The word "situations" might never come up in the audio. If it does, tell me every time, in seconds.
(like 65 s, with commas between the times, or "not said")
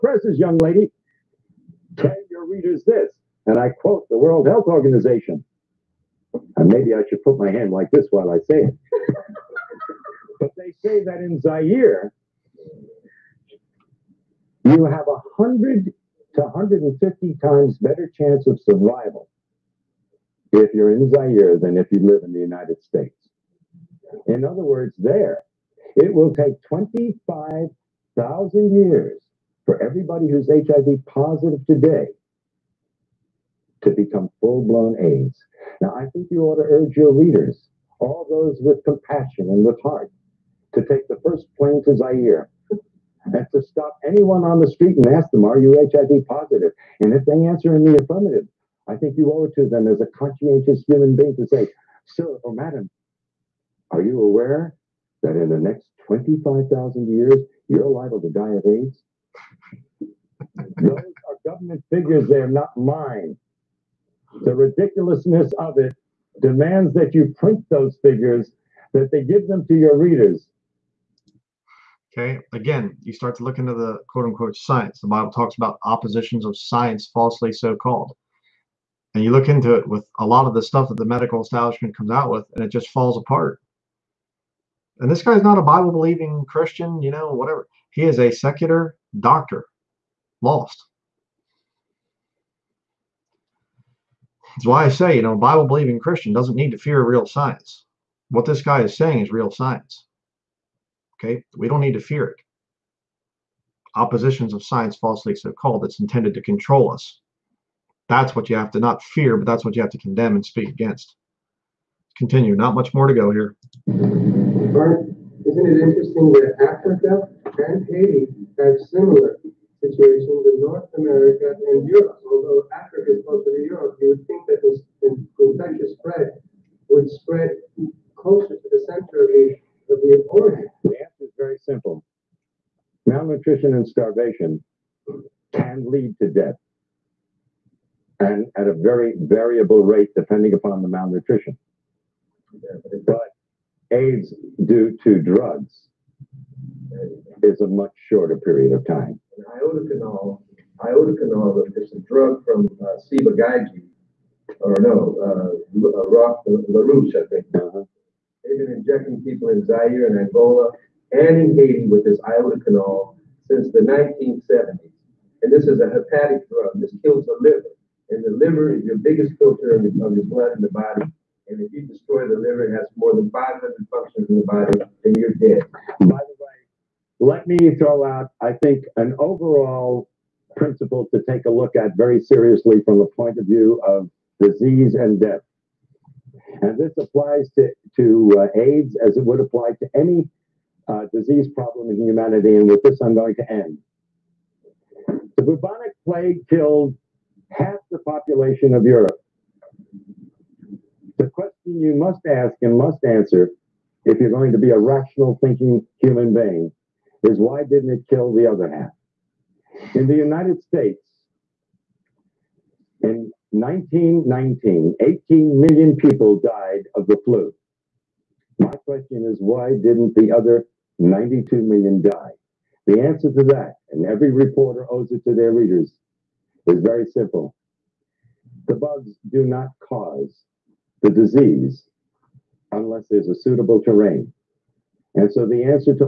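119 s.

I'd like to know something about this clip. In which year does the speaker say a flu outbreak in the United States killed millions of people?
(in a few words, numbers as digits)
1919.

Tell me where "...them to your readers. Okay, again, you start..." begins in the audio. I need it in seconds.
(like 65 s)
69 s.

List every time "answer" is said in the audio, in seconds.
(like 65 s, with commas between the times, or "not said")
47 s, 130 s, 203 s, 223 s.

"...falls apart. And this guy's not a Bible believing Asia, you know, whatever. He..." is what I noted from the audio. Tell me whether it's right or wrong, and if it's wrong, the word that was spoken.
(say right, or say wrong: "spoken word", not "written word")
wrong: "Christian", not "Asia".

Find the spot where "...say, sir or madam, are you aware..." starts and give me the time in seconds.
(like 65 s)
51 s.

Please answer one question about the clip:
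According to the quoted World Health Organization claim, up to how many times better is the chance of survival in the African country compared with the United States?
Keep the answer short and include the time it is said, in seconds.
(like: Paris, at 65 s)
150, at 16 s.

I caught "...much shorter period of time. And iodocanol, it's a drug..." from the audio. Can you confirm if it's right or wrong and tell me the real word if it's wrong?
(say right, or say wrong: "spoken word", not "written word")
right.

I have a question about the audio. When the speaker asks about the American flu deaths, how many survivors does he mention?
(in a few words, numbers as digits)
92 million.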